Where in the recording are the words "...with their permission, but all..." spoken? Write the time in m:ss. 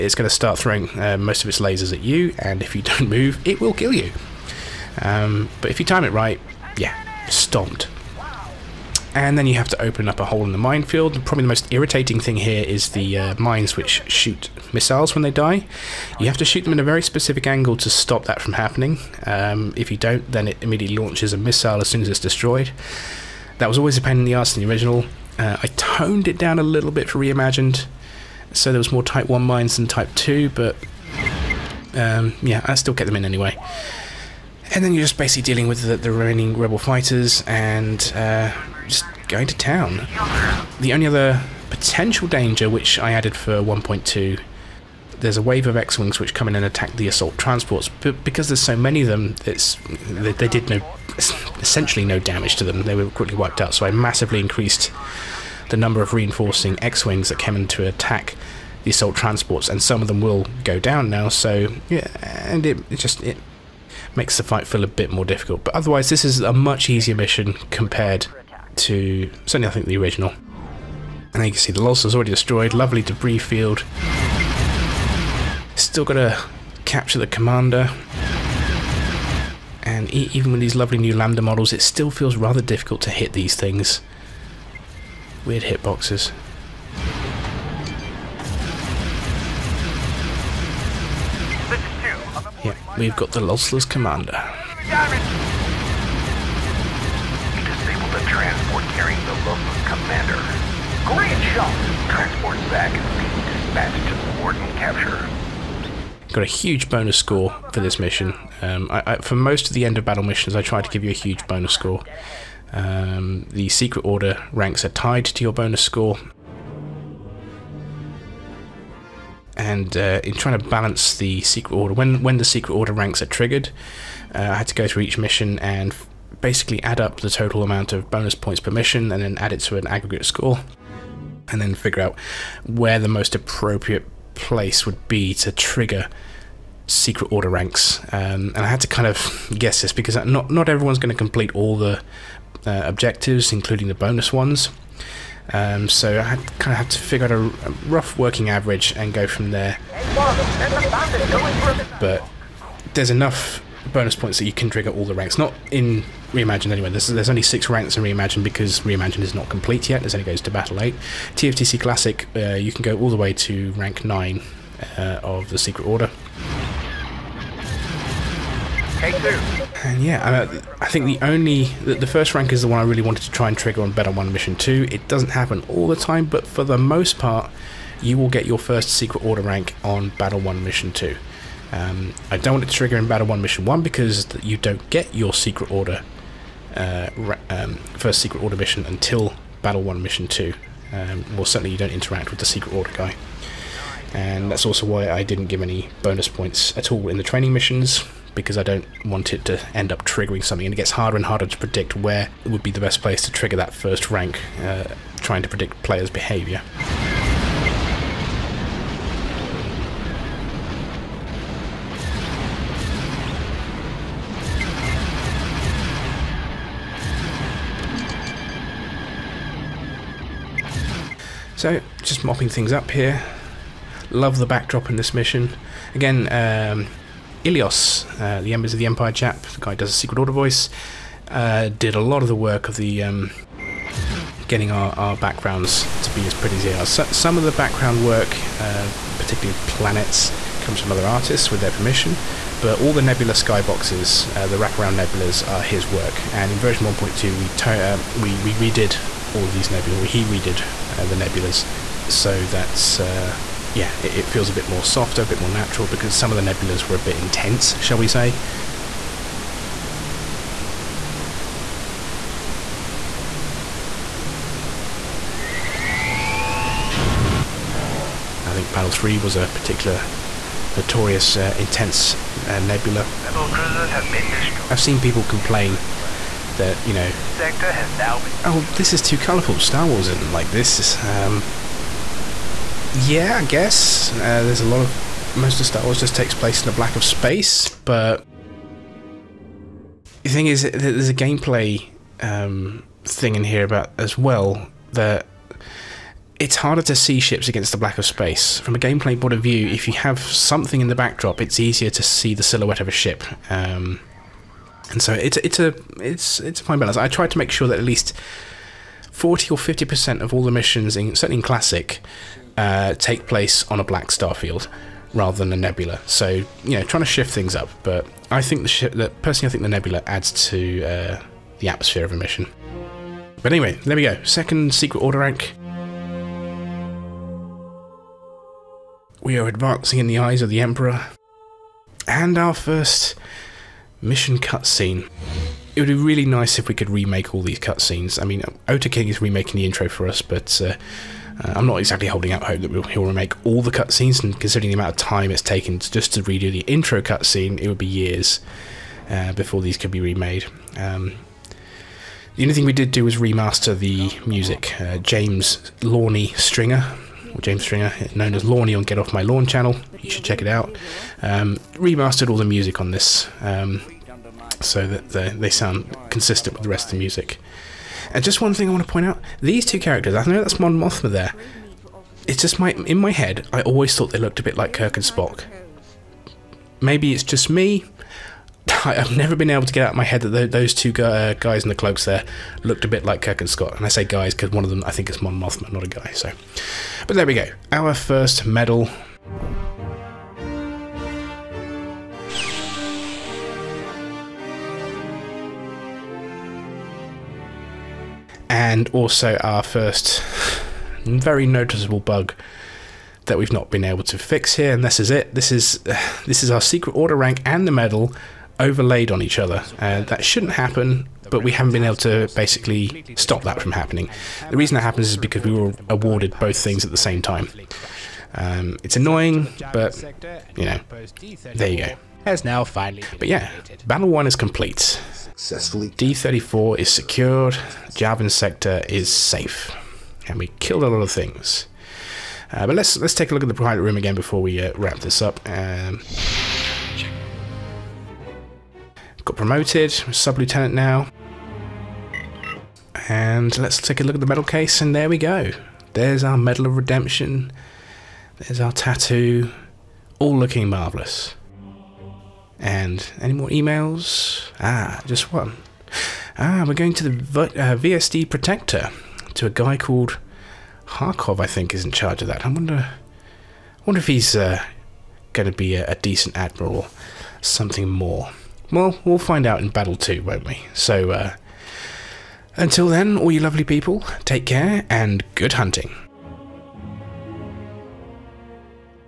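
4:01.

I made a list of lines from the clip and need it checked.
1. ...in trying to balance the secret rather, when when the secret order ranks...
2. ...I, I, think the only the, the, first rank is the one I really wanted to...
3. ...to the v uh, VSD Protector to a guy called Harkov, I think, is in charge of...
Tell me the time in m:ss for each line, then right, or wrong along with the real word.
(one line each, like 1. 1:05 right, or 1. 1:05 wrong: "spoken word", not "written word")
1. 2:00 wrong: "order", not "rather"
2. 2:50 right
3. 7:36 right.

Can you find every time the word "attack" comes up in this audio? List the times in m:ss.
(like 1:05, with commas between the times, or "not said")
0:46, 0:57.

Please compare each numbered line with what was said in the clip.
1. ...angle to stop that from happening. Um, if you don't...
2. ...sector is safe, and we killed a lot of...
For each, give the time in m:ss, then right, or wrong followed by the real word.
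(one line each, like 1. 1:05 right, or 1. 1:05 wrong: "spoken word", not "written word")
1. 0:17 right
2. 7:08 right.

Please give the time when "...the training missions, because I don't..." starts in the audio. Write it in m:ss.
3:17.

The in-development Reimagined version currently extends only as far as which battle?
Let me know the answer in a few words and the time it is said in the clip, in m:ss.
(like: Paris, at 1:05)
Battle 8, at 2:40.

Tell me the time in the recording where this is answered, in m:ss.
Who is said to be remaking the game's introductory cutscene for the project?
5:38.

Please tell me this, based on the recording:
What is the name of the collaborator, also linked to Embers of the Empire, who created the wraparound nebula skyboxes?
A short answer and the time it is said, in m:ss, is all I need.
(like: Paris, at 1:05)
Ilios, at 3:47.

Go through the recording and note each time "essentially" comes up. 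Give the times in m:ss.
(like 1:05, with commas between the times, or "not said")
0:51.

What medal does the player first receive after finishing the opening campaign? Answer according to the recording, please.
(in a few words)
Medal of Redemption.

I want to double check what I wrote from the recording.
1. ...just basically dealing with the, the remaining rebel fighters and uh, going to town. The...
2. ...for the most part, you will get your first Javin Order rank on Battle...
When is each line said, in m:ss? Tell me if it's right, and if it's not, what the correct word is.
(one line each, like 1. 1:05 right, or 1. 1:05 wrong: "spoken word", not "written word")
1. 0:35 right
2. 2:56 wrong: "Secret", not "Javin".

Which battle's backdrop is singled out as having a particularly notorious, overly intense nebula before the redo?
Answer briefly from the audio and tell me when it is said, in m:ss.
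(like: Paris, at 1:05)
Battle 3, at 4:28.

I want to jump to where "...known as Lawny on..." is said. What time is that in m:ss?
5:58.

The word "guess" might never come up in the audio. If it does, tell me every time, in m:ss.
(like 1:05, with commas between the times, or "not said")
2:19, 4:43.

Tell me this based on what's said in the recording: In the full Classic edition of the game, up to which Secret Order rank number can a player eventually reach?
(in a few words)
9.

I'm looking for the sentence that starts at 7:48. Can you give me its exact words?
Well, we'll find out in Battle 2, won't we?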